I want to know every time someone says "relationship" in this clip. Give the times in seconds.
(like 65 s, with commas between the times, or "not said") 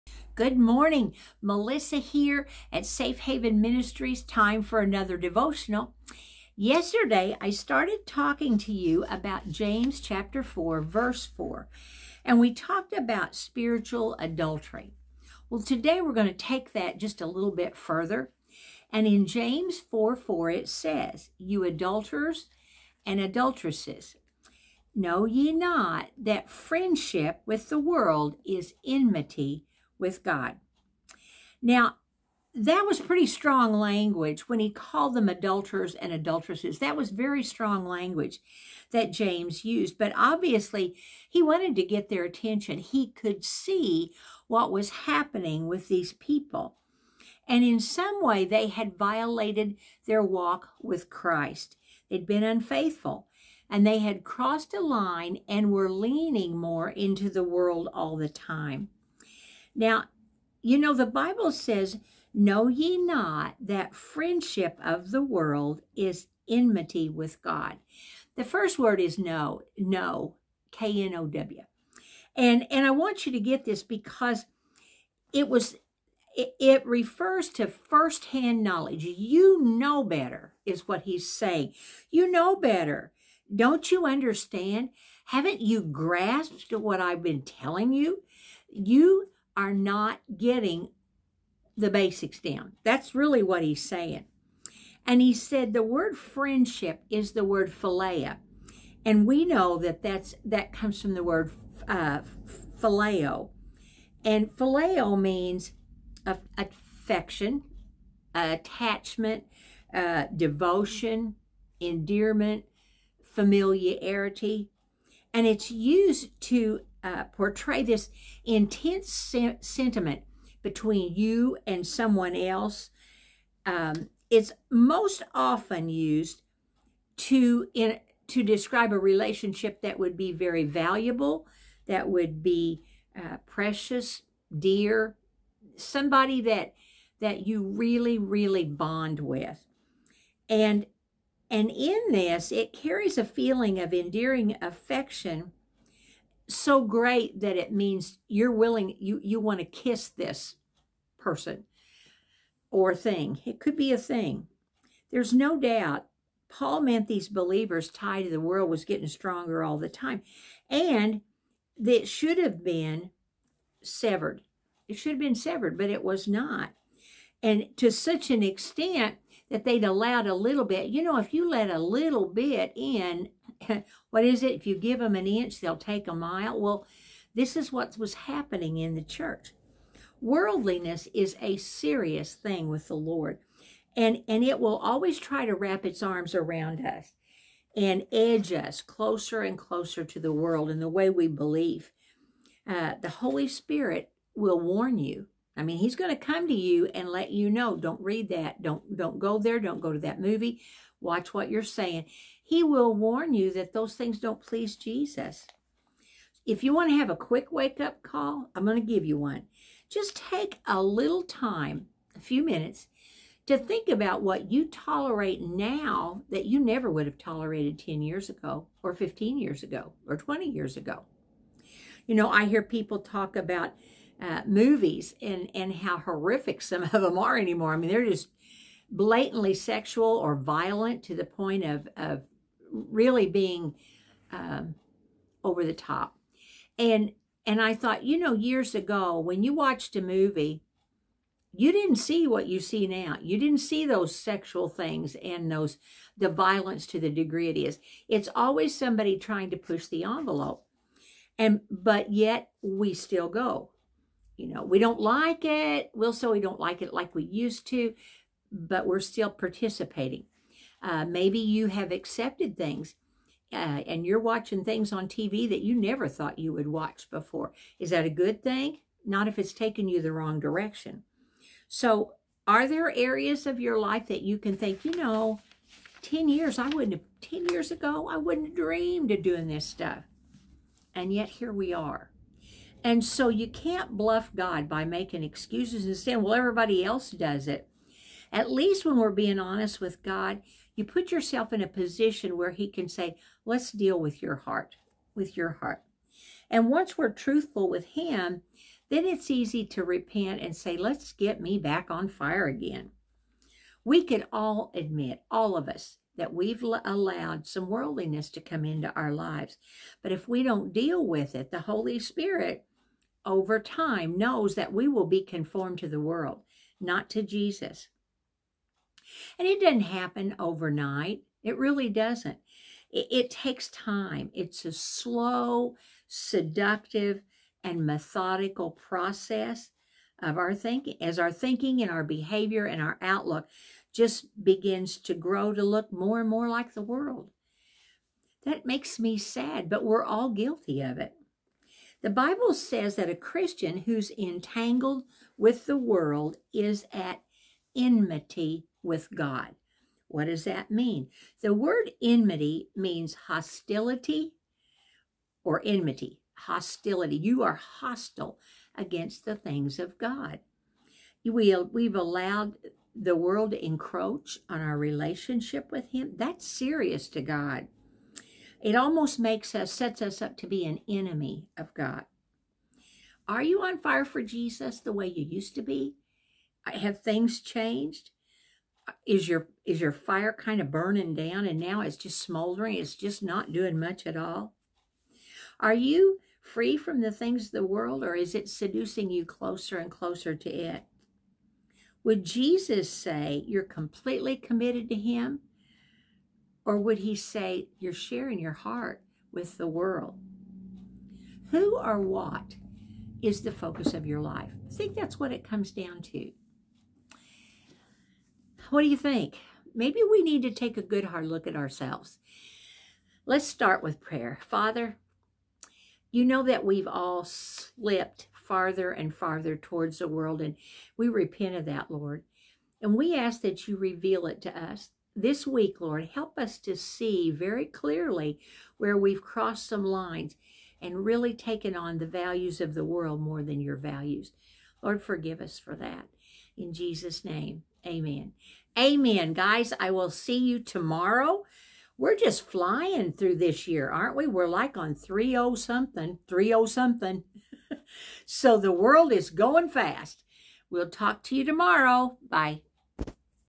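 128 s, 364 s.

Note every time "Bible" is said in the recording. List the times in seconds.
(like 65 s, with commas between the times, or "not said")
61 s, 342 s.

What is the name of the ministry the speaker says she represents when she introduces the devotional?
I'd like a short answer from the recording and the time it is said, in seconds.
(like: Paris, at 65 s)
Safe Haven Ministries, at 2 s.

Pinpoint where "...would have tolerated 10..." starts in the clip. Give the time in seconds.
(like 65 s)
216 s.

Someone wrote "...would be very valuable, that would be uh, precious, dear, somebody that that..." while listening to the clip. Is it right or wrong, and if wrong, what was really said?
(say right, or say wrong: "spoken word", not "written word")
right.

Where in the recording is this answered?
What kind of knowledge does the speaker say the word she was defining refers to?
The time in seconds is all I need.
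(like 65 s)
77 s.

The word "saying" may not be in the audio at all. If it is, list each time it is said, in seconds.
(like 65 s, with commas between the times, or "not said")
81 s, 93 s, 201 s, 285 s.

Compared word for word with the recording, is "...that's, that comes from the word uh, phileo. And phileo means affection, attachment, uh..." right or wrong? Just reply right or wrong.
right.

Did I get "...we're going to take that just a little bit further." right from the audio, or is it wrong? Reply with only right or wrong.
right.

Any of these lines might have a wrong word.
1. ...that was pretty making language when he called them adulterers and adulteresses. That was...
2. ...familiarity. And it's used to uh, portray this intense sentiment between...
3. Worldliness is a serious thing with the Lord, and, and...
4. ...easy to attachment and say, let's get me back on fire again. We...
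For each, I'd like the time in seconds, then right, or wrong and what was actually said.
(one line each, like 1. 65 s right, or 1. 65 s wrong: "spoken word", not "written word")
1. 32 s wrong: "strong", not "making"
2. 113 s right
3. 180 s right
4. 299 s wrong: "repent", not "attachment".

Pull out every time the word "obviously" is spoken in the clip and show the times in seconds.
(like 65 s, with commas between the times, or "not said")
40 s.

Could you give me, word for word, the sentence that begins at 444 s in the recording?
We're like on 30 something, 30 something.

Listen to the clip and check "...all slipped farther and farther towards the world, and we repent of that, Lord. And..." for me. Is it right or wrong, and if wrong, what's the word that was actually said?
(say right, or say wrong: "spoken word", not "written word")
right.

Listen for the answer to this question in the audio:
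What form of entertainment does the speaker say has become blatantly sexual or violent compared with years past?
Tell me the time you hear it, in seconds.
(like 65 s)
224 s.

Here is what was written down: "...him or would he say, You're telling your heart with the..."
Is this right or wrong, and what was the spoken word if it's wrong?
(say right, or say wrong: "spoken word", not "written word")
wrong: "sharing", not "telling".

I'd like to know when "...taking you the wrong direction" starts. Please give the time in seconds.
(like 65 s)
269 s.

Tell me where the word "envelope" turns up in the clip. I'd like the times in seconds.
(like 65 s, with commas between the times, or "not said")
250 s.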